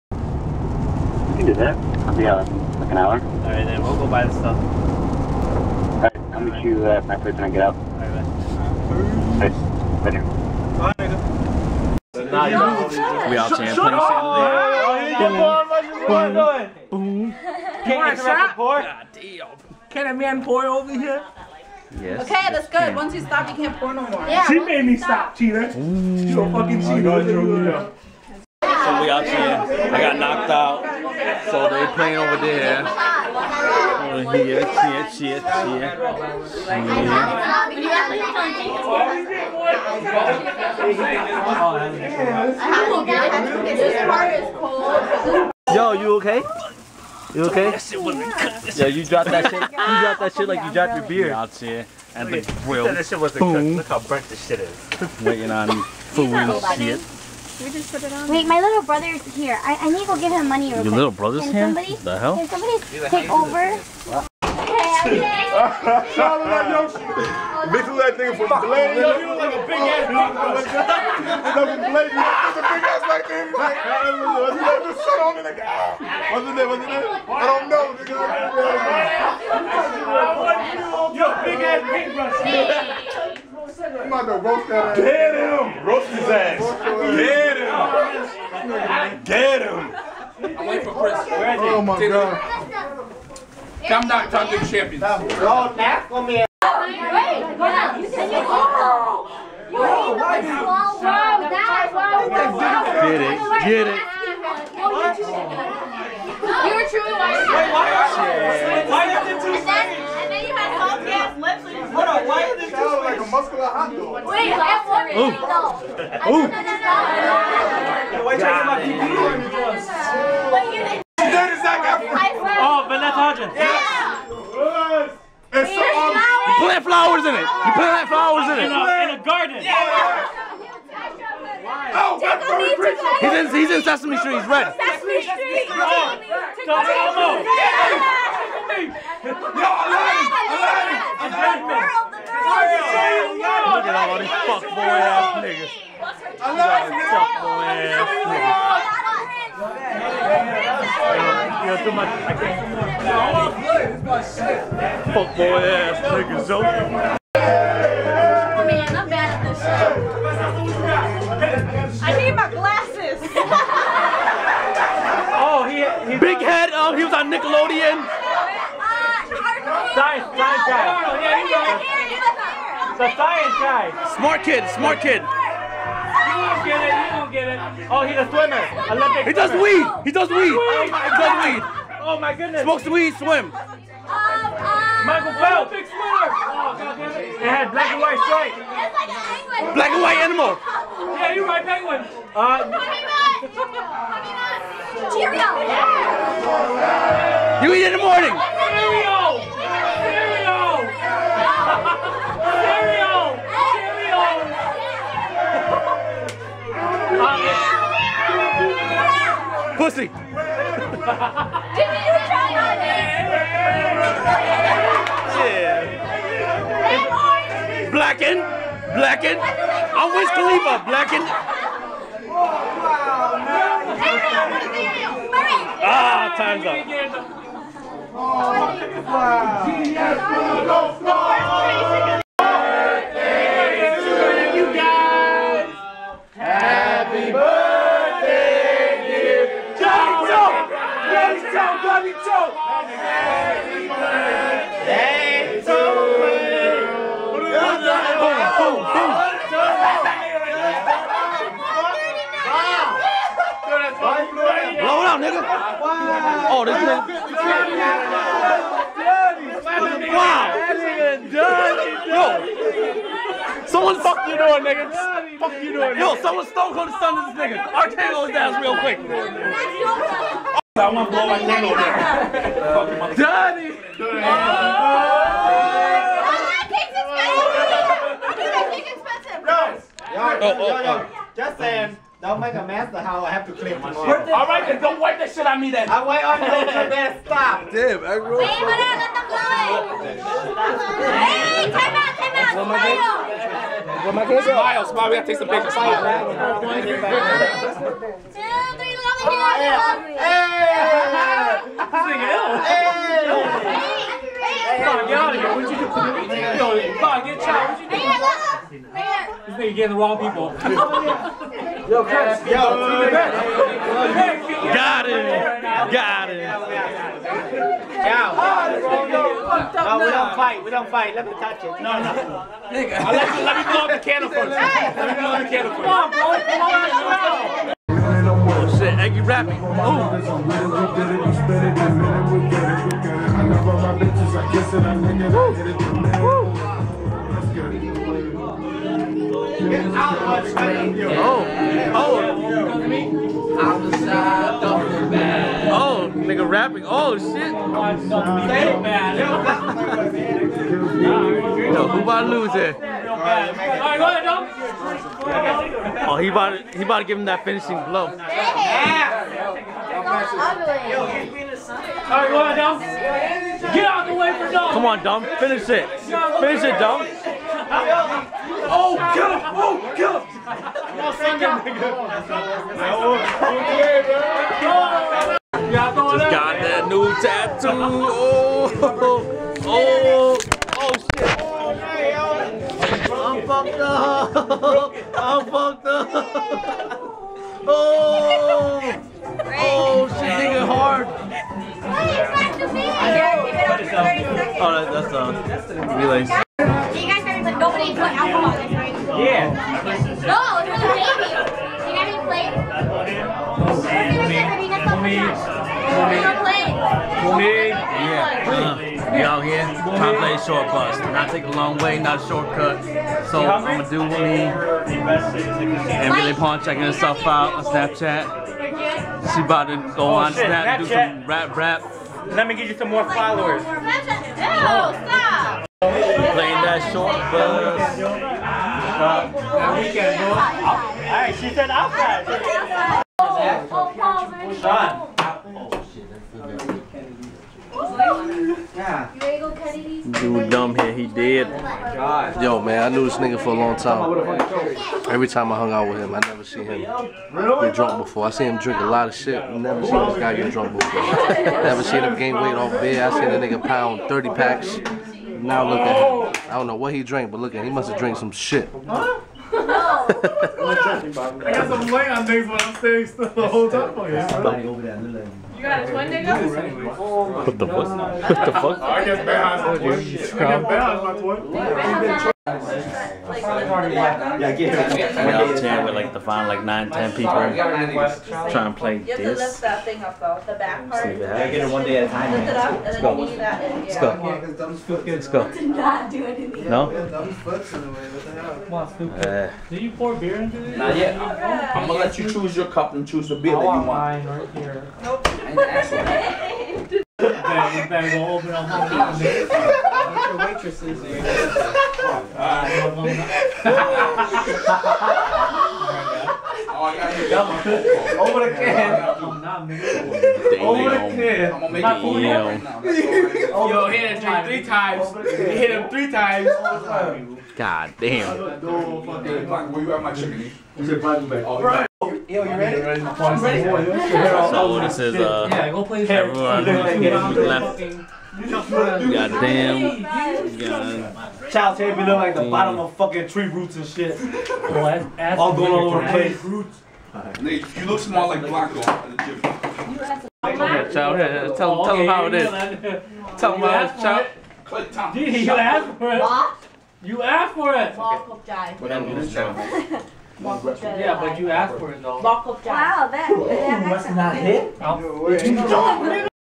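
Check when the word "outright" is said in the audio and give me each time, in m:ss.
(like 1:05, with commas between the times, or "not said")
not said.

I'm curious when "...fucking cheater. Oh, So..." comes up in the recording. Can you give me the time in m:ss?
0:26.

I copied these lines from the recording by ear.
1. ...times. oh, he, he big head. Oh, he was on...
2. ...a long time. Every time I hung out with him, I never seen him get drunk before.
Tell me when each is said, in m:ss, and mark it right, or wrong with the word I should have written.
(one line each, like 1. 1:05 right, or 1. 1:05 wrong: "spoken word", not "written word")
1. 2:42 wrong: "glasses", not "times"
2. 7:23 right.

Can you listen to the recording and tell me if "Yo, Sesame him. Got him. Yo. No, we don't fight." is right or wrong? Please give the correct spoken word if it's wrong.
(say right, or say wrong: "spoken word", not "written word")
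wrong: "Got", not "Sesame".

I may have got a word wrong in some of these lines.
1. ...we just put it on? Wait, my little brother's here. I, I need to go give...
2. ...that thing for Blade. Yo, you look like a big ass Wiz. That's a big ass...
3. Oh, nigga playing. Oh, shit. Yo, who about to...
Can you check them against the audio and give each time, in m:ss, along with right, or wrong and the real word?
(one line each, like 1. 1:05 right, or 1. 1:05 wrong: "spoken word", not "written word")
1. 0:57 right
2. 1:08 wrong: "Blade", not "Wiz"
3. 5:45 wrong: "rapping", not "playing".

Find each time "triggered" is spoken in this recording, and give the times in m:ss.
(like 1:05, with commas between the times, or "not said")
not said.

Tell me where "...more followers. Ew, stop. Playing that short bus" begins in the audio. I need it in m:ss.
7:02.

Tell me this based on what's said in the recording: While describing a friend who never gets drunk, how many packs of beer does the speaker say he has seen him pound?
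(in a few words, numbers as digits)
30.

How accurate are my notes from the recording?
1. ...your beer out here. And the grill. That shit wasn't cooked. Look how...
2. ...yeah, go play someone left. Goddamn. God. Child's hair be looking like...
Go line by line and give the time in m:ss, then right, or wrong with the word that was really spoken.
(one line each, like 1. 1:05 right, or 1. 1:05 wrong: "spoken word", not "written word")
1. 0:50 right
2. 8:45 wrong: "everyone", not "someone".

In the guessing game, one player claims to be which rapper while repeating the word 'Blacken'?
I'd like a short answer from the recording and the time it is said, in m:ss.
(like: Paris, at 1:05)
Wiz Khalifa, at 3:40.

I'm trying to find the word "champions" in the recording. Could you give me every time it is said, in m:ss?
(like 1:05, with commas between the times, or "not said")
0:13, 1:34.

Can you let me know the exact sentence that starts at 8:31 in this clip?
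I'm gonna make it Yo, hit him three times.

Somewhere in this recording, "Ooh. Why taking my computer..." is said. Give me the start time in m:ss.
1:56.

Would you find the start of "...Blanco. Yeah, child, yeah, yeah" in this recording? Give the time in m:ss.
8:58.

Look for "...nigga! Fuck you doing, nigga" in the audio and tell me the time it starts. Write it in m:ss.
4:24.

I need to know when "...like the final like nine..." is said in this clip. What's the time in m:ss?
7:55.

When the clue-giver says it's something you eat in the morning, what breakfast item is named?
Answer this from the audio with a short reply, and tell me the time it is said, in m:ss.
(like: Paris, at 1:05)
Cheerio, at 3:15.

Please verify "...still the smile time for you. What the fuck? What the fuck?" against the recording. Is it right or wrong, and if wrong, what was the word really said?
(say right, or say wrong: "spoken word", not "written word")
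wrong: "whole", not "smile".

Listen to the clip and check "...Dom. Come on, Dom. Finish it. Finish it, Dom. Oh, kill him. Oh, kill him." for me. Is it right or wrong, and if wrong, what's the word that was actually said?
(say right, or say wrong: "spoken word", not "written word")
right.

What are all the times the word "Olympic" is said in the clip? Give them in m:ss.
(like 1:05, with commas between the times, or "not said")
2:58, 3:05.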